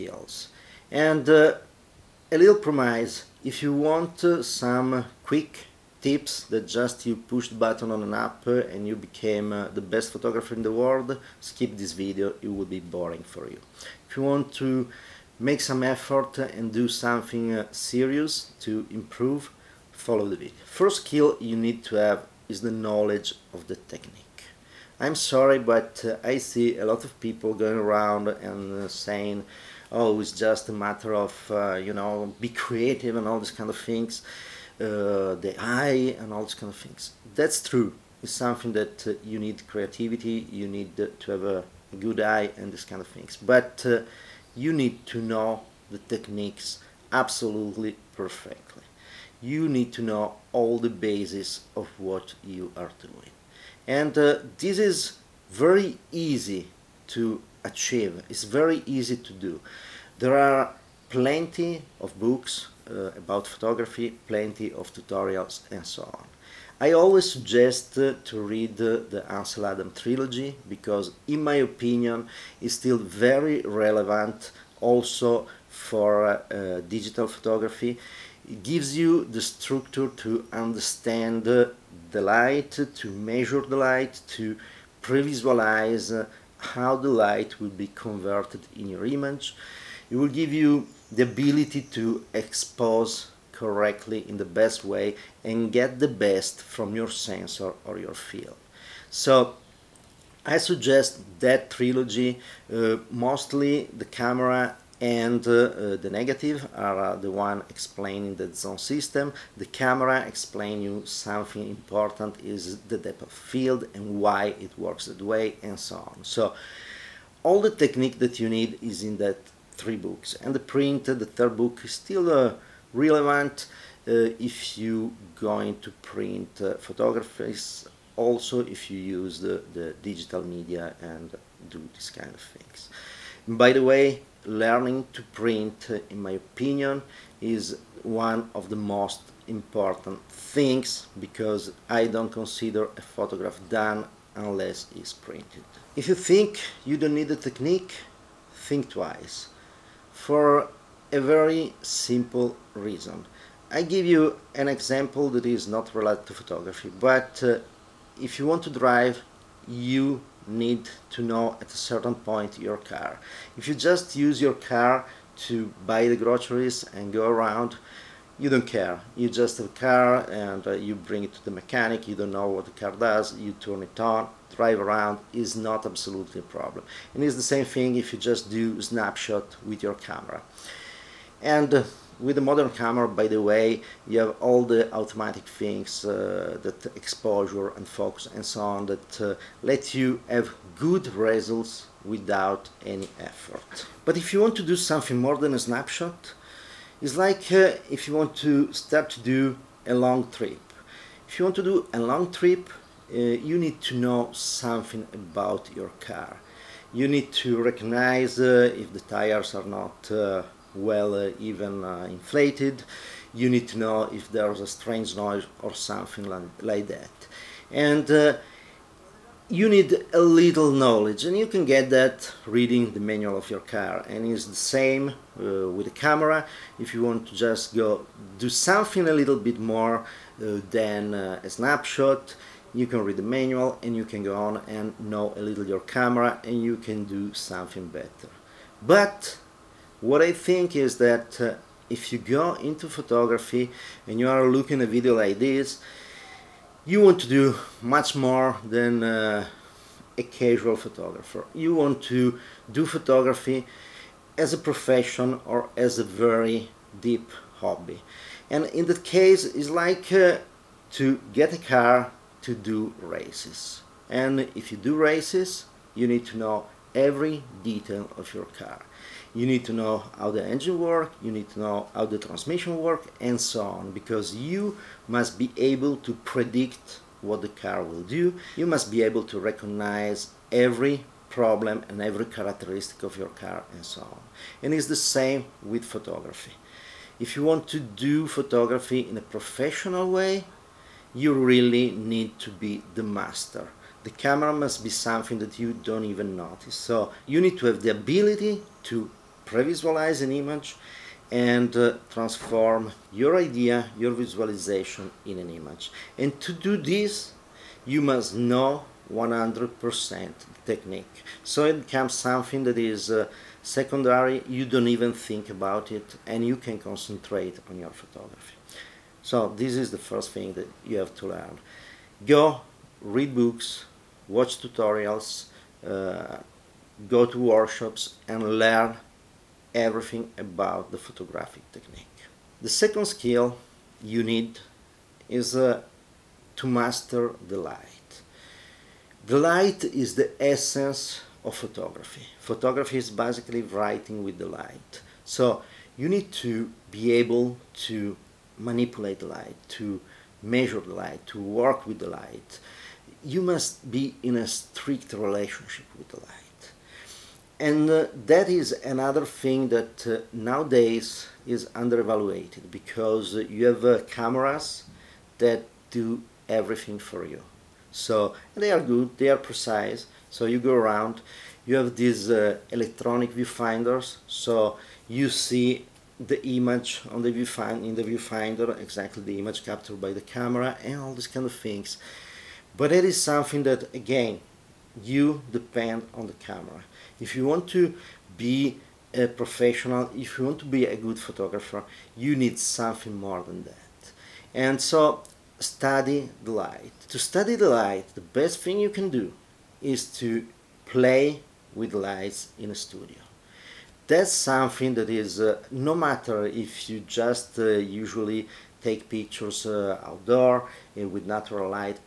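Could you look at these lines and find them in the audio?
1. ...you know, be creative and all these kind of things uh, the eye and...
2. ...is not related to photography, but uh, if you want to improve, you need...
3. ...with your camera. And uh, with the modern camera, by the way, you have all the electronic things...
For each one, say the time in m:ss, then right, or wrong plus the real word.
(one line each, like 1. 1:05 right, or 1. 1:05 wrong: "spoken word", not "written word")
1. 0:31 right
2. 2:35 wrong: "drive", not "improve"
3. 2:59 wrong: "automatic", not "electronic".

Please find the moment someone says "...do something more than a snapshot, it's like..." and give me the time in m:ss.
3:14.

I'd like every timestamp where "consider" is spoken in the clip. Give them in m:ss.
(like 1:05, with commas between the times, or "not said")
2:22.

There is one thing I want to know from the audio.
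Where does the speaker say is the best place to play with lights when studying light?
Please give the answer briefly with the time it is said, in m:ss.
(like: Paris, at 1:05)
In a studio, at 6:42.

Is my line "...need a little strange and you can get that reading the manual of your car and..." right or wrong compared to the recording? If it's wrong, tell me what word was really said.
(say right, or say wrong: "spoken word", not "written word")
wrong: "knowledge", not "strange".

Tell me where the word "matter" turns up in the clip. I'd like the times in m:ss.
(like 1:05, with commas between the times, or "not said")
0:30, 6:45.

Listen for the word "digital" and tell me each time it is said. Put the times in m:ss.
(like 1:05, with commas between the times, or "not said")
1:16, 2:10.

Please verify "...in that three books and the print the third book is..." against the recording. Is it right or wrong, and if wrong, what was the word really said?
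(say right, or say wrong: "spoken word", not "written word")
right.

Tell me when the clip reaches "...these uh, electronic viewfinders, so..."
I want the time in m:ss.
6:11.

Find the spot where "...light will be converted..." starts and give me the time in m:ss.
1:27.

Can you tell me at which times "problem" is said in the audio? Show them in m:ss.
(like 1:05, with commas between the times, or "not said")
2:56, 4:41.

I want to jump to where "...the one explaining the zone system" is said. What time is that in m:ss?
1:47.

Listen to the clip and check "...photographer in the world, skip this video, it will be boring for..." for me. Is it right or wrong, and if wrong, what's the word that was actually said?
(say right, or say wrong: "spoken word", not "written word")
right.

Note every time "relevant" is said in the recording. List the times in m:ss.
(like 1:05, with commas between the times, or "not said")
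1:13, 2:02.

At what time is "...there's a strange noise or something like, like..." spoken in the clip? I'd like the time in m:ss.
3:34.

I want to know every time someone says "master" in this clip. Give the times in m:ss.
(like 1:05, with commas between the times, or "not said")
4:53, 5:36.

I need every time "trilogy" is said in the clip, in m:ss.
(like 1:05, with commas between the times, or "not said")
1:09, 1:41.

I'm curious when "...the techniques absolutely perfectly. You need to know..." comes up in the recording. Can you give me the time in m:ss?
0:45.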